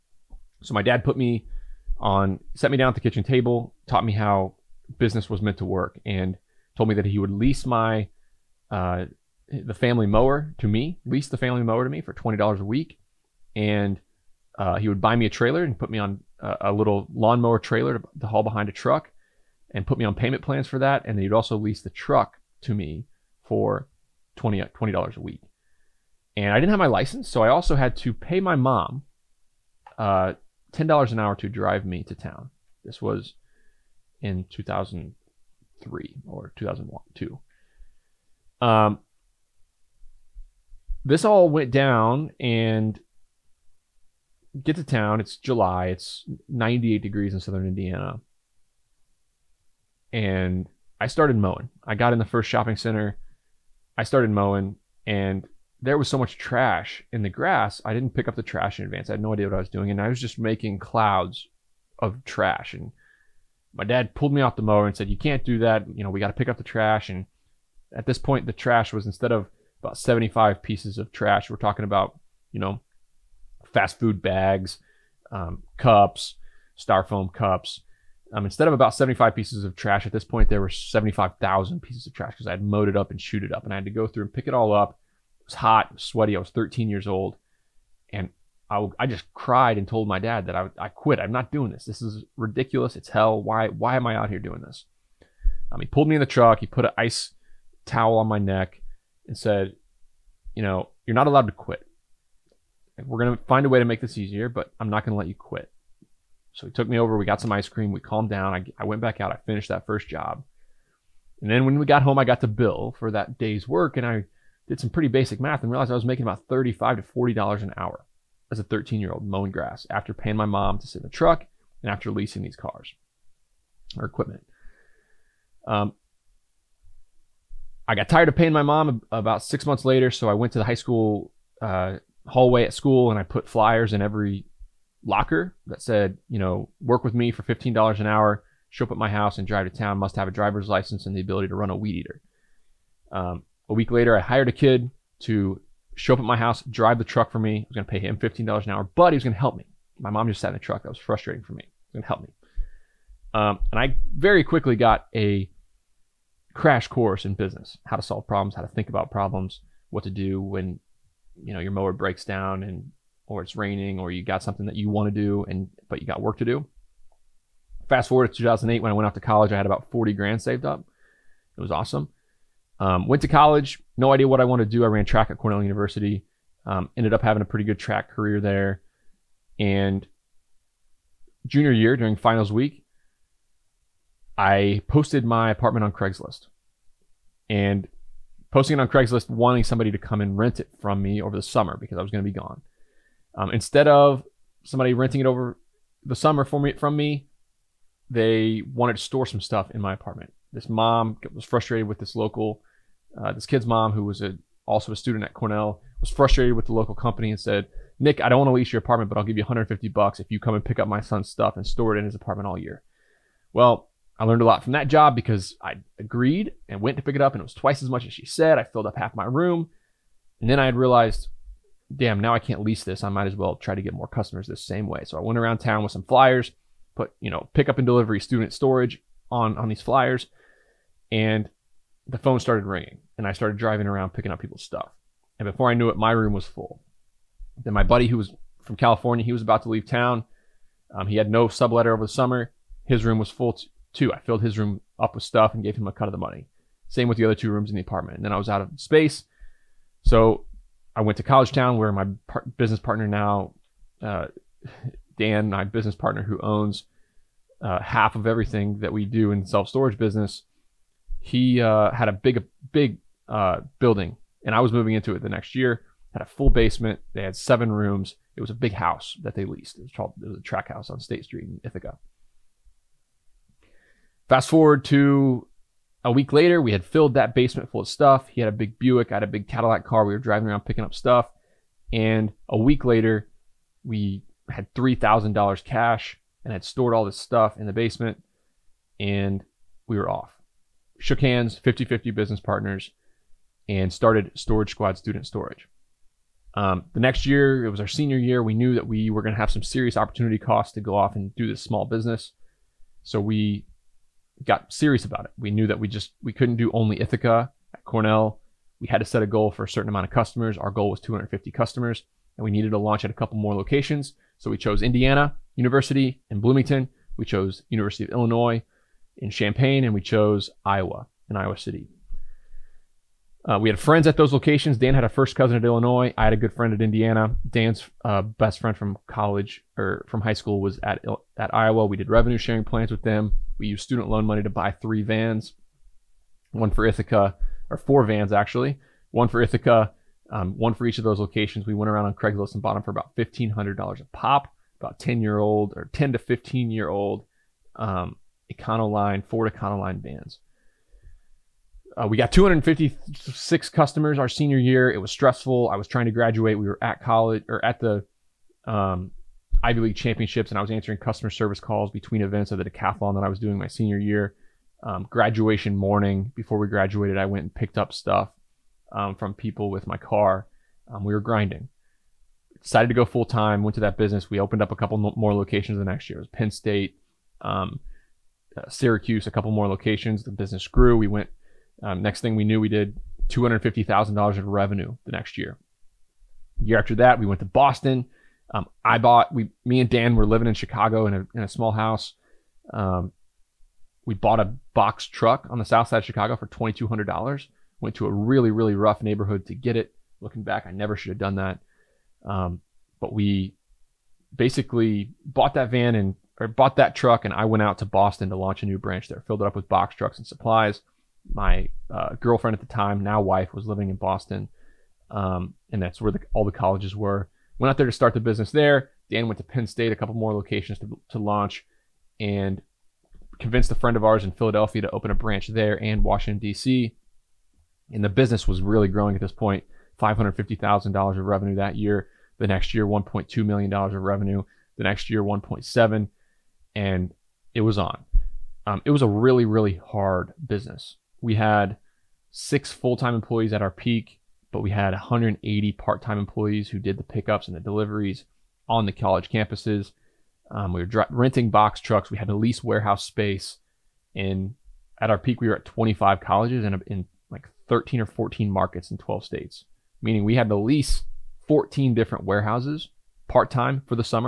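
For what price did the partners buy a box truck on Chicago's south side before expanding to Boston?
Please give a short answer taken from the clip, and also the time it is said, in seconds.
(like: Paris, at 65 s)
$2,200, at 396 s.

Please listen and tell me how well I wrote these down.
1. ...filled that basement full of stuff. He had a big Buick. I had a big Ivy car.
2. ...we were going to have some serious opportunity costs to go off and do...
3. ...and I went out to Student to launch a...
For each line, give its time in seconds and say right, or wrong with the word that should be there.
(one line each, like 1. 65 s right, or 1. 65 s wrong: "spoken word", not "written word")
1. 276 s wrong: "Cadillac", not "Ivy"
2. 298 s right
3. 407 s wrong: "Boston", not "Student".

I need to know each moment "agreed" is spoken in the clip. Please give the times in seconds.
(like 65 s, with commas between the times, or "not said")
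215 s.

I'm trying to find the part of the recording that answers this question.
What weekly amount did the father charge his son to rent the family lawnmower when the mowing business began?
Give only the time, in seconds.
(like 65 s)
12 s.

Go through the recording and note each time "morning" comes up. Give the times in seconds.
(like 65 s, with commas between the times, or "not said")
365 s.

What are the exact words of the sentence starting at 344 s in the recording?
About ten year old or ten to fifteen year old um, Econoline, Ford Econoline vans.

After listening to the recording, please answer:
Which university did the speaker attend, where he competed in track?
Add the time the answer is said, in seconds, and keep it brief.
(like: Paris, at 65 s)
Cornell University, at 175 s.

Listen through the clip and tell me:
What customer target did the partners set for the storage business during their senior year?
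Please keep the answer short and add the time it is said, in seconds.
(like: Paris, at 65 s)
250 customers, at 310 s.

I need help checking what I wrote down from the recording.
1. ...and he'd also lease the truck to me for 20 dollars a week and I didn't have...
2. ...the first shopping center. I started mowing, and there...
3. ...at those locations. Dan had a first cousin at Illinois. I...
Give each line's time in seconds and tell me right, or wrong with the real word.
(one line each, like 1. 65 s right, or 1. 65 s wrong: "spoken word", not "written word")
1. 21 s right
2. 52 s right
3. 324 s right.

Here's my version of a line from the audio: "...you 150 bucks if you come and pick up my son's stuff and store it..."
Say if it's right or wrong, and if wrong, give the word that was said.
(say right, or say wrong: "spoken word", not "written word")
right.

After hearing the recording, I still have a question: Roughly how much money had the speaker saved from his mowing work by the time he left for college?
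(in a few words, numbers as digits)
$40,000.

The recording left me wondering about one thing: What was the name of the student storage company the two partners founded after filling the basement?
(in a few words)
Storage Squad.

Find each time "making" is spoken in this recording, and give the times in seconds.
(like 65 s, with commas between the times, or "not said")
60 s, 116 s.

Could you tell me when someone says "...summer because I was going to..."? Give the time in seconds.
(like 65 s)
191 s.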